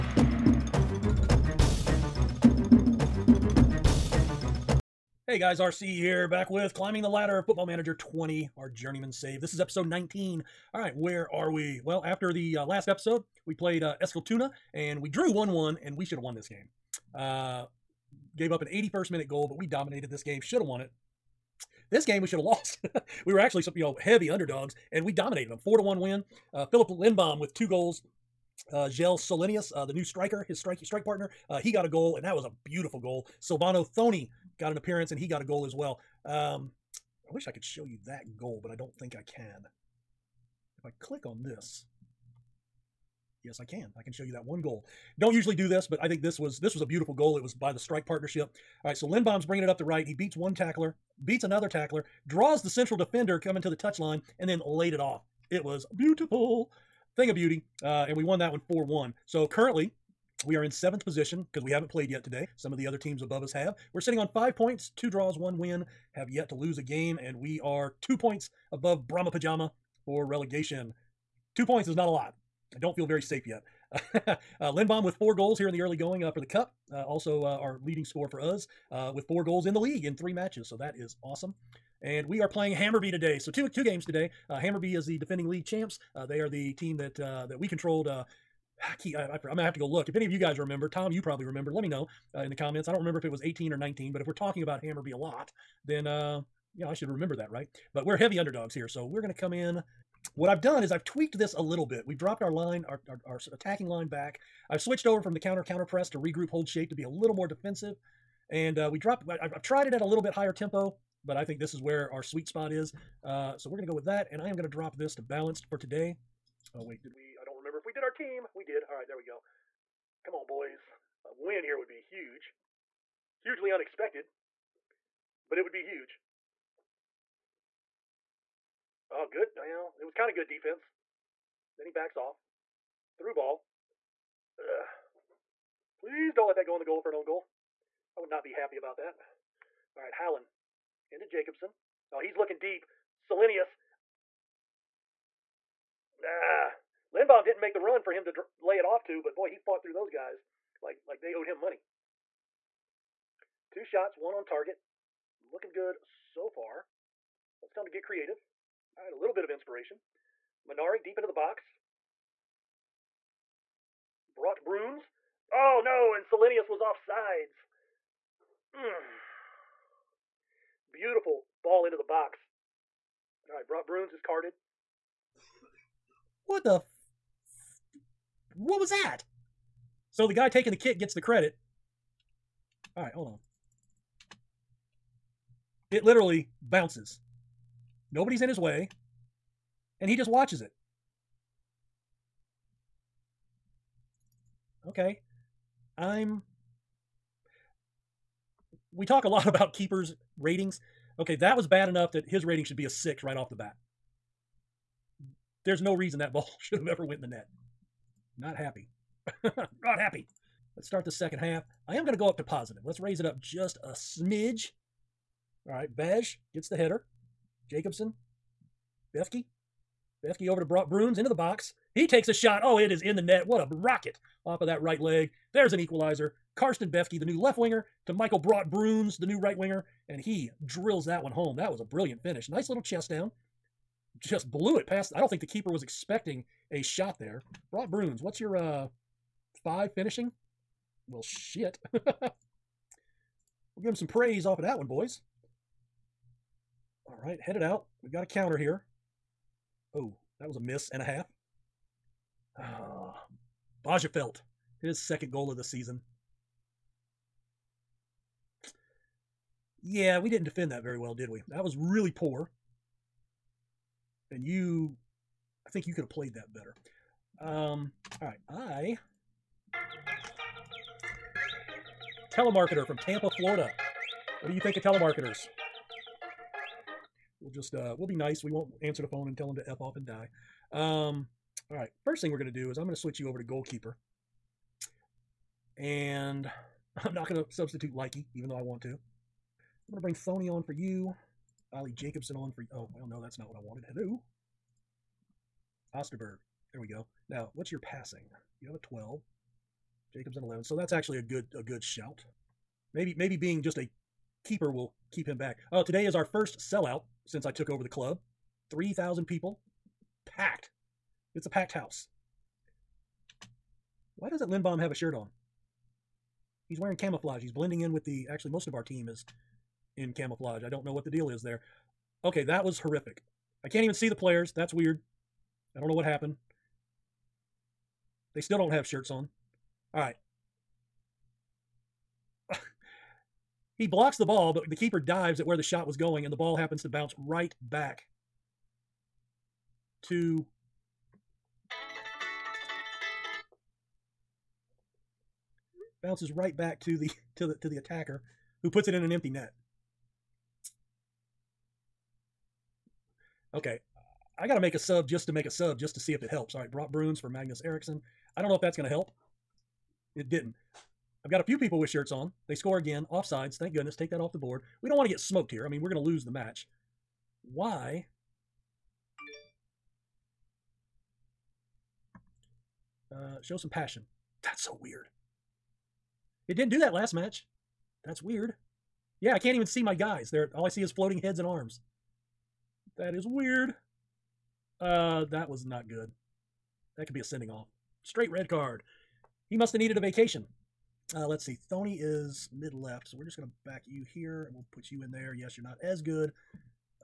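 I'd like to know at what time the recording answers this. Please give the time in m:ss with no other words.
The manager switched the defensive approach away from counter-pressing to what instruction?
1:46.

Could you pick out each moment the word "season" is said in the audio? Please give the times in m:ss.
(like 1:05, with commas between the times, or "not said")
4:15.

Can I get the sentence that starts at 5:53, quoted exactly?
Okay, I got to make a sub just to make a sub just to see if it helps.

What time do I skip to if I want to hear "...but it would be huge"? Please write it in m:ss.
2:05.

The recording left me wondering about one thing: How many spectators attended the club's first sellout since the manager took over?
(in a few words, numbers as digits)
3,000.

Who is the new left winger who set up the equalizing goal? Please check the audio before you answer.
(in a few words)
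Karsten Befke.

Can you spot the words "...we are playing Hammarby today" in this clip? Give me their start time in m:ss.
1:22.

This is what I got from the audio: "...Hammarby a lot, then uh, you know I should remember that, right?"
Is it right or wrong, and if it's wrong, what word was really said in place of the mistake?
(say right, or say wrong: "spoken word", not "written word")
right.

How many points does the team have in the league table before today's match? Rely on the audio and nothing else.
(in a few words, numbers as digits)
5.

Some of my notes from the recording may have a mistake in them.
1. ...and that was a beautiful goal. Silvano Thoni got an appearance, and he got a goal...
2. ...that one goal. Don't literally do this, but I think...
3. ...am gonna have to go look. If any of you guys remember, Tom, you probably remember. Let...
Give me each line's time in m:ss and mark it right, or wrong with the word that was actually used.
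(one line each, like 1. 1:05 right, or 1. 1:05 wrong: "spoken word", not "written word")
1. 0:32 right
2. 0:44 wrong: "usually", not "literally"
3. 1:29 right.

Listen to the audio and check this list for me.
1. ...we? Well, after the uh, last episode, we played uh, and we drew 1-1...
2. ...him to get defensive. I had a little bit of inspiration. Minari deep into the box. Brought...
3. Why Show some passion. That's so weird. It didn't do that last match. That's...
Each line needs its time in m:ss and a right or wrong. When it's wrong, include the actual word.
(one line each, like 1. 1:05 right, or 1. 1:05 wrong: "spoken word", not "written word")
1. 0:11 right
2. 2:37 wrong: "creative", not "defensive"
3. 6:07 right.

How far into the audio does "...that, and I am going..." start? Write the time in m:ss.
1:54.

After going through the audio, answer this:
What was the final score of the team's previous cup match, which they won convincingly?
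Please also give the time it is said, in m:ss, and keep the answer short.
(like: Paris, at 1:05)
4-1, at 0:25.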